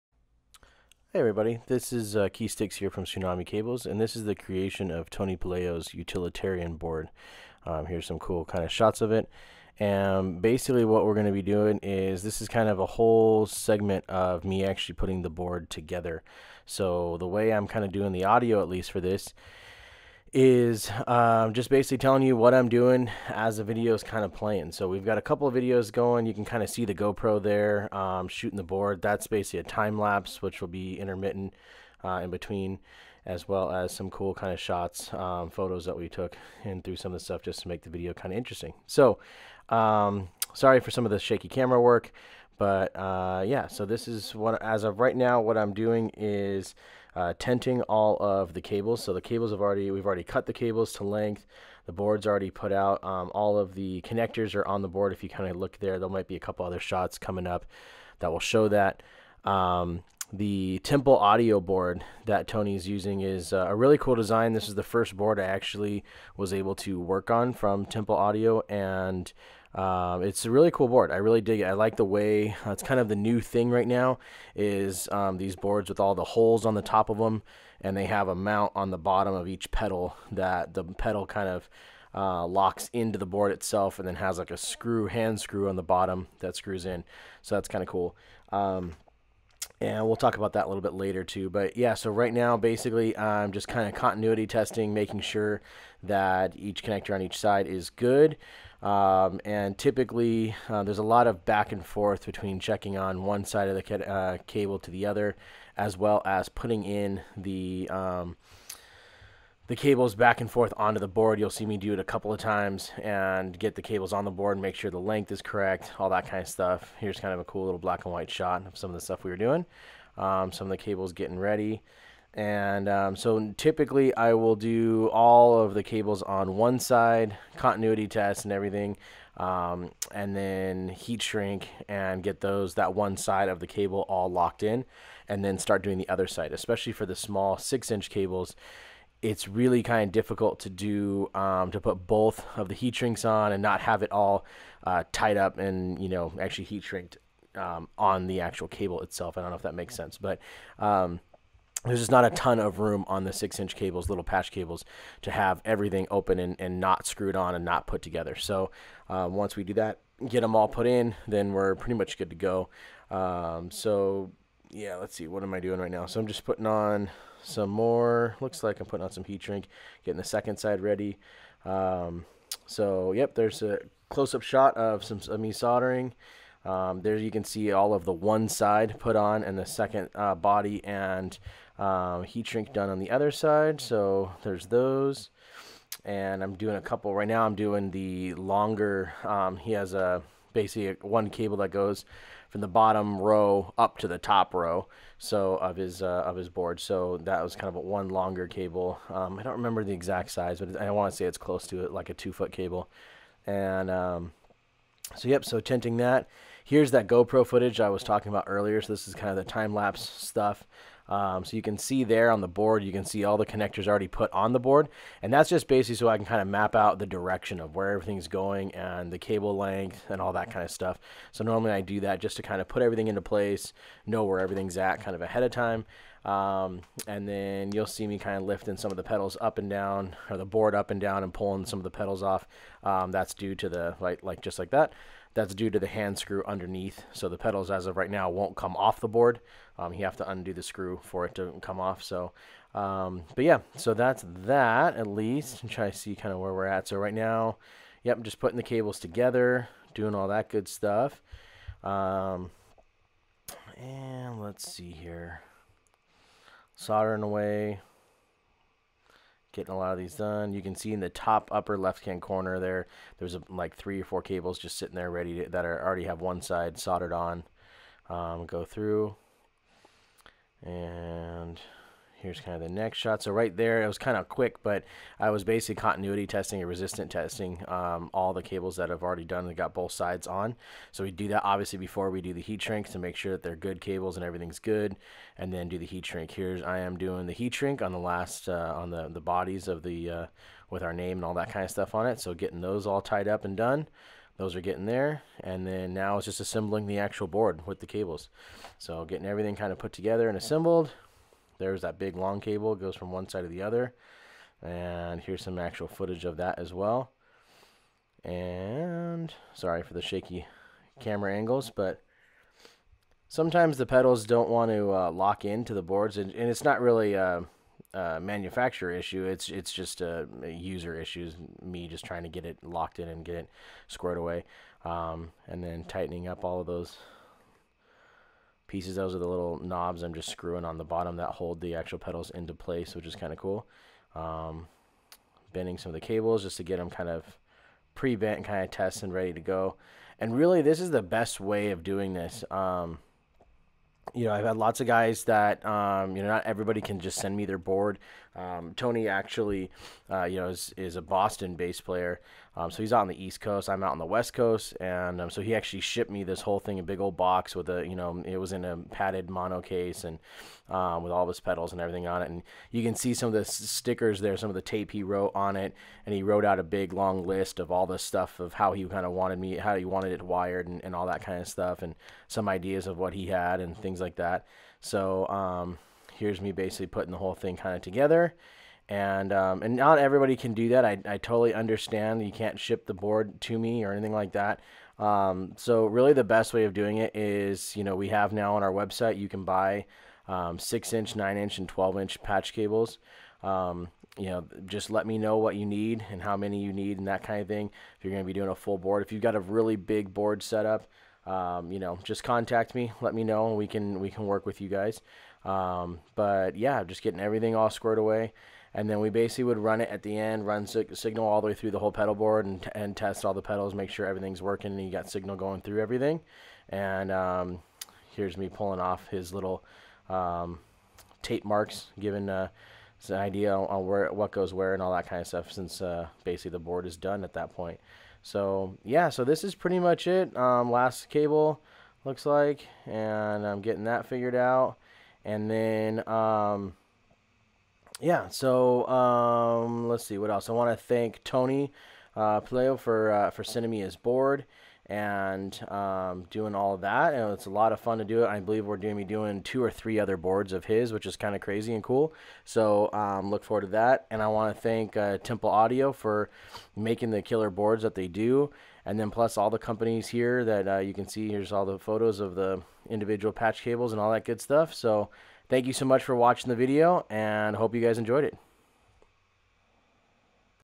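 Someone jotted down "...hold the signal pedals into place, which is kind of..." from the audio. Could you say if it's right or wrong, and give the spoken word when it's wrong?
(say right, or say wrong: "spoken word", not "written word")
wrong: "actual", not "signal".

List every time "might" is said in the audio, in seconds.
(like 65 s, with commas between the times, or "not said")
56 s.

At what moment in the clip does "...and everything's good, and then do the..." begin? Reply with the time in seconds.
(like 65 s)
284 s.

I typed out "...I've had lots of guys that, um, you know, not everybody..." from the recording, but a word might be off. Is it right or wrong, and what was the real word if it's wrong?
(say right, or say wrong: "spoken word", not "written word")
right.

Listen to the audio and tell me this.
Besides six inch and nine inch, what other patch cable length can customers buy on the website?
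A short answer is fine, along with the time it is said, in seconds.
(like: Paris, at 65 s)
12 inch, at 391 s.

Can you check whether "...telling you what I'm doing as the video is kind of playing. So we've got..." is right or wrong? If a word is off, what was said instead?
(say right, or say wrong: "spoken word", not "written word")
right.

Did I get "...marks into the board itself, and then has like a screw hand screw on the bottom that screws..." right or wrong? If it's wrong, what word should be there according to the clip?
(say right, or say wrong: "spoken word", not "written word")
wrong: "locks", not "marks".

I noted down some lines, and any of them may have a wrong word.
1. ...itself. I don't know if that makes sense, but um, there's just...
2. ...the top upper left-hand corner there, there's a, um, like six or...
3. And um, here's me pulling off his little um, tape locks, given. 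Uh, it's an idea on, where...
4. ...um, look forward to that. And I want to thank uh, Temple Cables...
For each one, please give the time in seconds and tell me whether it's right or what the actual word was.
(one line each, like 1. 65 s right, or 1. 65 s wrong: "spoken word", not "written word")
1. 149 s right
2. 260 s wrong: "three", not "six"
3. 416 s wrong: "marks", not "locks"
4. 452 s wrong: "Audio", not "Cables".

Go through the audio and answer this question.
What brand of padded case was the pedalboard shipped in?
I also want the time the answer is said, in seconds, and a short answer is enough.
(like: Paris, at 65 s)
Mono, at 359 s.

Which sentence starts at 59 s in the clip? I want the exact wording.
Um, the Temple audio board that Tony's using is uh, a really cool design.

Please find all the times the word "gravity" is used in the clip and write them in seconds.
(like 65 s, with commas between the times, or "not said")
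not said.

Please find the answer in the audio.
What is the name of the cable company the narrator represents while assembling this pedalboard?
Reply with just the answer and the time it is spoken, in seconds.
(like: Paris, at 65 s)
Tsunami Cables, at 3 s.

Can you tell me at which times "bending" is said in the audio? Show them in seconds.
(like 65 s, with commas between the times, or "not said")
335 s.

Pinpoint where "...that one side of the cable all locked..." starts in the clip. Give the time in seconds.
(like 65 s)
132 s.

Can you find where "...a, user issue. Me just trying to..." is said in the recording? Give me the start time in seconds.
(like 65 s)
320 s.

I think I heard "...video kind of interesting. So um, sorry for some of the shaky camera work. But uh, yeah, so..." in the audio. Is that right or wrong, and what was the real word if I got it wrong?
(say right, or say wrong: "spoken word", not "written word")
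right.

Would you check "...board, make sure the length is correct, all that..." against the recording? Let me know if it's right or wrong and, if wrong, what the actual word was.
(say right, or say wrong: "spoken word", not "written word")
right.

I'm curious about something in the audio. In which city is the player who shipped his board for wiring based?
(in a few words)
Boston.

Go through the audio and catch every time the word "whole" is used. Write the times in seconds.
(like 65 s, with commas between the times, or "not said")
12 s, 356 s, 377 s, 411 s.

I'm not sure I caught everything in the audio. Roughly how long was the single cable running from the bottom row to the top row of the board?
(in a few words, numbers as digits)
2 feet.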